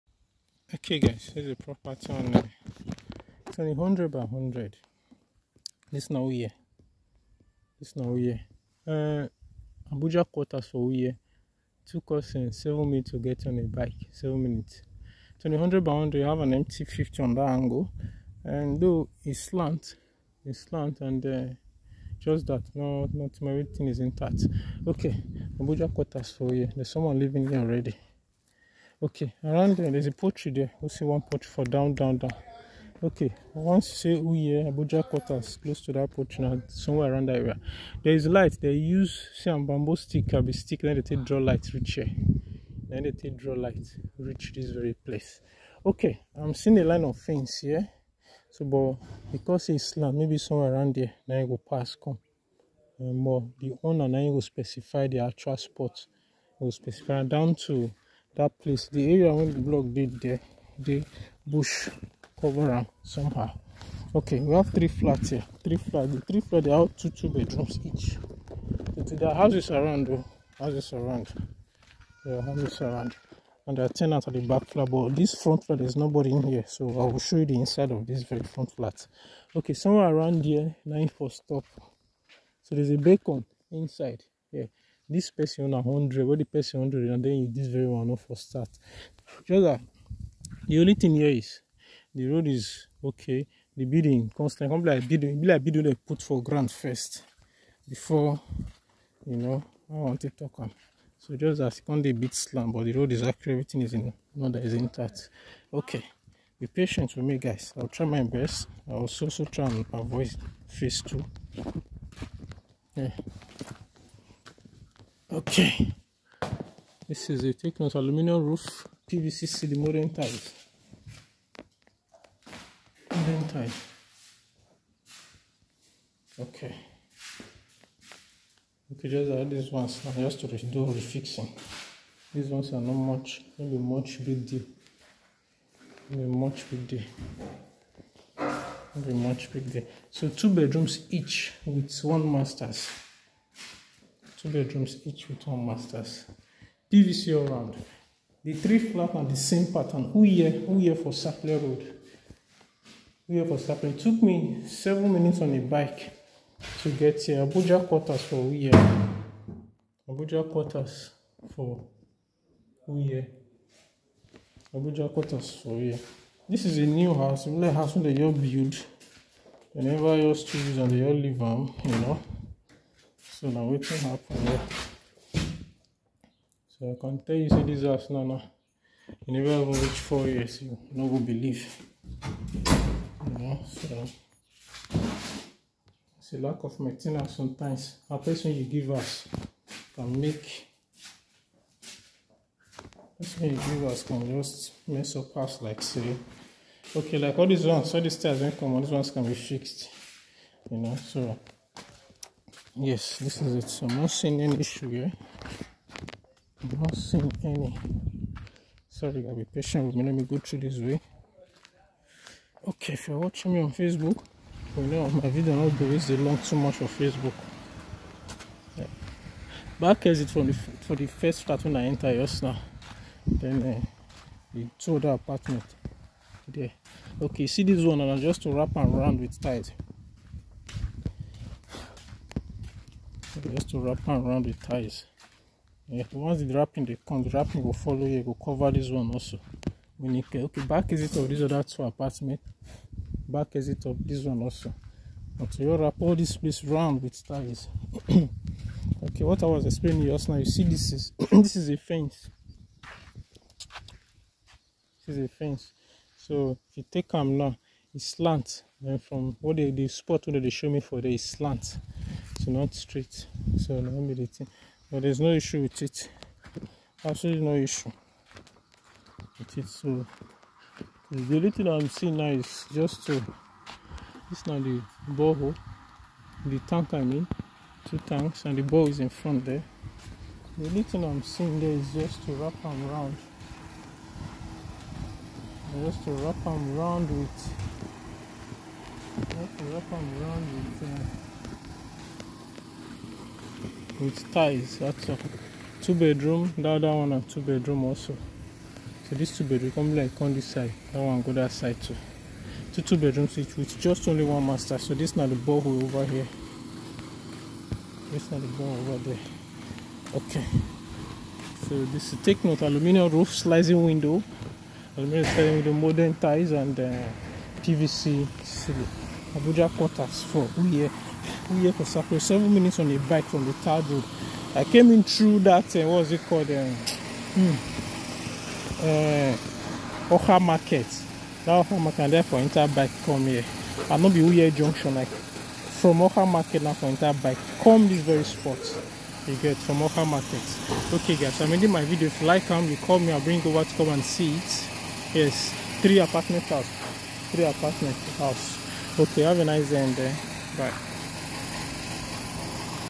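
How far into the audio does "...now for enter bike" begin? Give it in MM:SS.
05:36.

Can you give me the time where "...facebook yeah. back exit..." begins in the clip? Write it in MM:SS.
03:36.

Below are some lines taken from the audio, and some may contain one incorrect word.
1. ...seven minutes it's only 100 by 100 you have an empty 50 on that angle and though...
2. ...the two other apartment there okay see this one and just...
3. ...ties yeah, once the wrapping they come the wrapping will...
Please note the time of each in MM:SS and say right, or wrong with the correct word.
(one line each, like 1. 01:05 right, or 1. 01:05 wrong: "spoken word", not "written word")
1. 00:14 right
2. 03:44 right
3. 03:54 right.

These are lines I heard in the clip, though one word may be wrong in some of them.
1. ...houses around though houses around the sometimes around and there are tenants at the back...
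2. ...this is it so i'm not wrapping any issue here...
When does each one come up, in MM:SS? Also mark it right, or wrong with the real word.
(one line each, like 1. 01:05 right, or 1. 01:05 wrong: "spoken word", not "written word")
1. 01:09 wrong: "houses", not "sometimes"
2. 03:23 wrong: "seeing", not "wrapping".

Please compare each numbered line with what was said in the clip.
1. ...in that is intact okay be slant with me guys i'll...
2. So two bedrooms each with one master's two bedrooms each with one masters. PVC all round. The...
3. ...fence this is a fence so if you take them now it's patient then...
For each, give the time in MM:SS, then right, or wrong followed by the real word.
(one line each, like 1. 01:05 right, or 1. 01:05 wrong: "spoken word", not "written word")
1. 01:43 wrong: "patient", not "slant"
2. 02:20 right
3. 04:11 wrong: "slant", not "patient".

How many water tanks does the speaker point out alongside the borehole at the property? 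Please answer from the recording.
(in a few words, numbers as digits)
2.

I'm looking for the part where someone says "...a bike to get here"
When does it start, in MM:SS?
02:35.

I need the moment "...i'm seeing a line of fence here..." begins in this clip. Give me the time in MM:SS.
00:46.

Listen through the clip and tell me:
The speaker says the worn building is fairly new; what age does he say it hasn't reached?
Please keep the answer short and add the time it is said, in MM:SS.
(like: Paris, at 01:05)
4 years, at 03:00.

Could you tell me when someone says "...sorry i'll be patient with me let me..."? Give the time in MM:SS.
03:28.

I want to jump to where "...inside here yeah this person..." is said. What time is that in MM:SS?
01:23.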